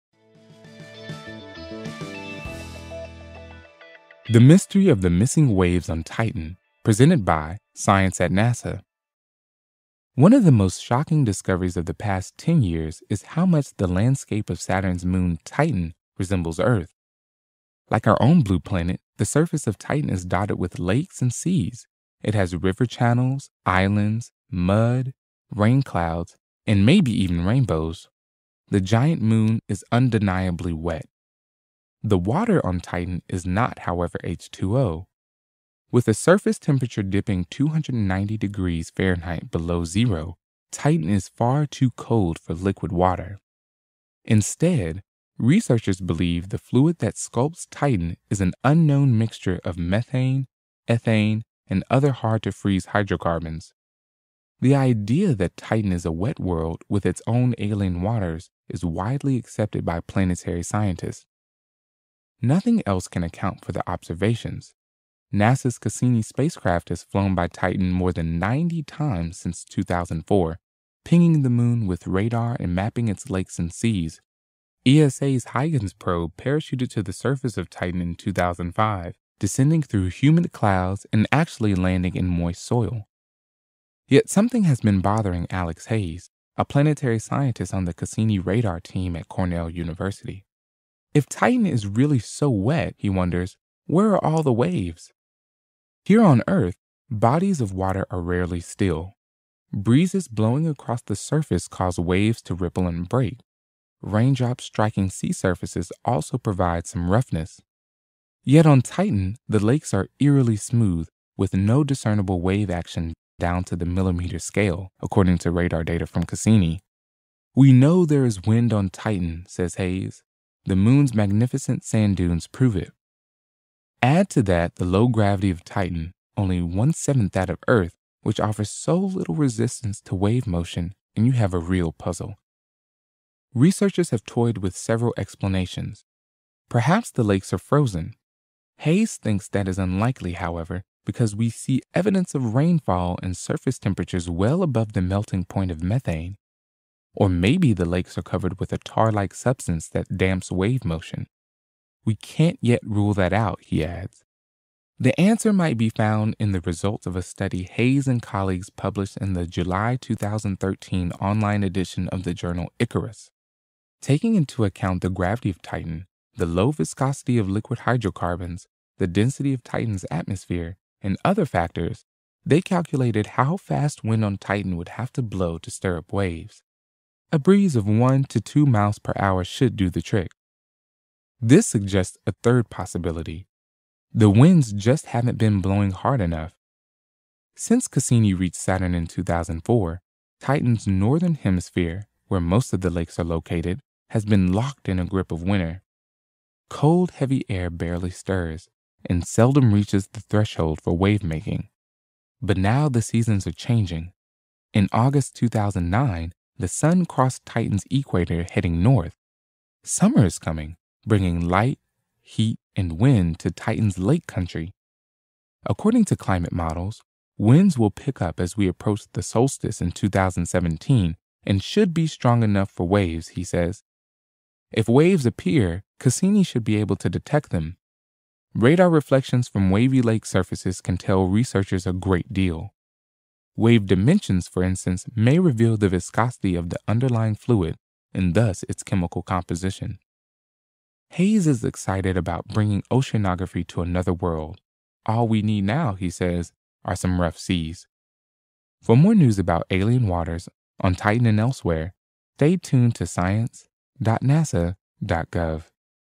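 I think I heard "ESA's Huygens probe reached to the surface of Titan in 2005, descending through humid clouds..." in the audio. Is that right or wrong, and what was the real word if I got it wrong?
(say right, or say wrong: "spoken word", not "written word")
wrong: "parachuted", not "reached".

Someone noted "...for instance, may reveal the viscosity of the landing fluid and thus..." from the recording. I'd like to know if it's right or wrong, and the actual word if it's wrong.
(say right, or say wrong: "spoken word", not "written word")
wrong: "underlying", not "landing".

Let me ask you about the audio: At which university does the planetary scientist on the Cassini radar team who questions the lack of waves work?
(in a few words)
Cornell University.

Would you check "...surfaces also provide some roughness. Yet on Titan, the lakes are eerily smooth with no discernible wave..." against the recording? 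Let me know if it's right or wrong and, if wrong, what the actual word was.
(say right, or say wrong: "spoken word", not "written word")
right.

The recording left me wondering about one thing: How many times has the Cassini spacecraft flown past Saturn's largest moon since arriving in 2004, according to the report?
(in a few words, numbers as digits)
more than 90.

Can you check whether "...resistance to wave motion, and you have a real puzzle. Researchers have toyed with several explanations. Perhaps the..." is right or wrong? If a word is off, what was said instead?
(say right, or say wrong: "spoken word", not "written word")
right.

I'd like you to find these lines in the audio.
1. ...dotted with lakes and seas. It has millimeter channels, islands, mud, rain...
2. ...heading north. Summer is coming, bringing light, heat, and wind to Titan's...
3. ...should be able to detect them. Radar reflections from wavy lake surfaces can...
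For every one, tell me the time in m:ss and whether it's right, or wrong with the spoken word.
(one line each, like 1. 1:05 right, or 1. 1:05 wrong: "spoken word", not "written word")
1. 0:20 wrong: "river", not "millimeter"
2. 3:28 right
3. 3:46 right.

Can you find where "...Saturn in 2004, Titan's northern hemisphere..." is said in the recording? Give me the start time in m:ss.
3:08.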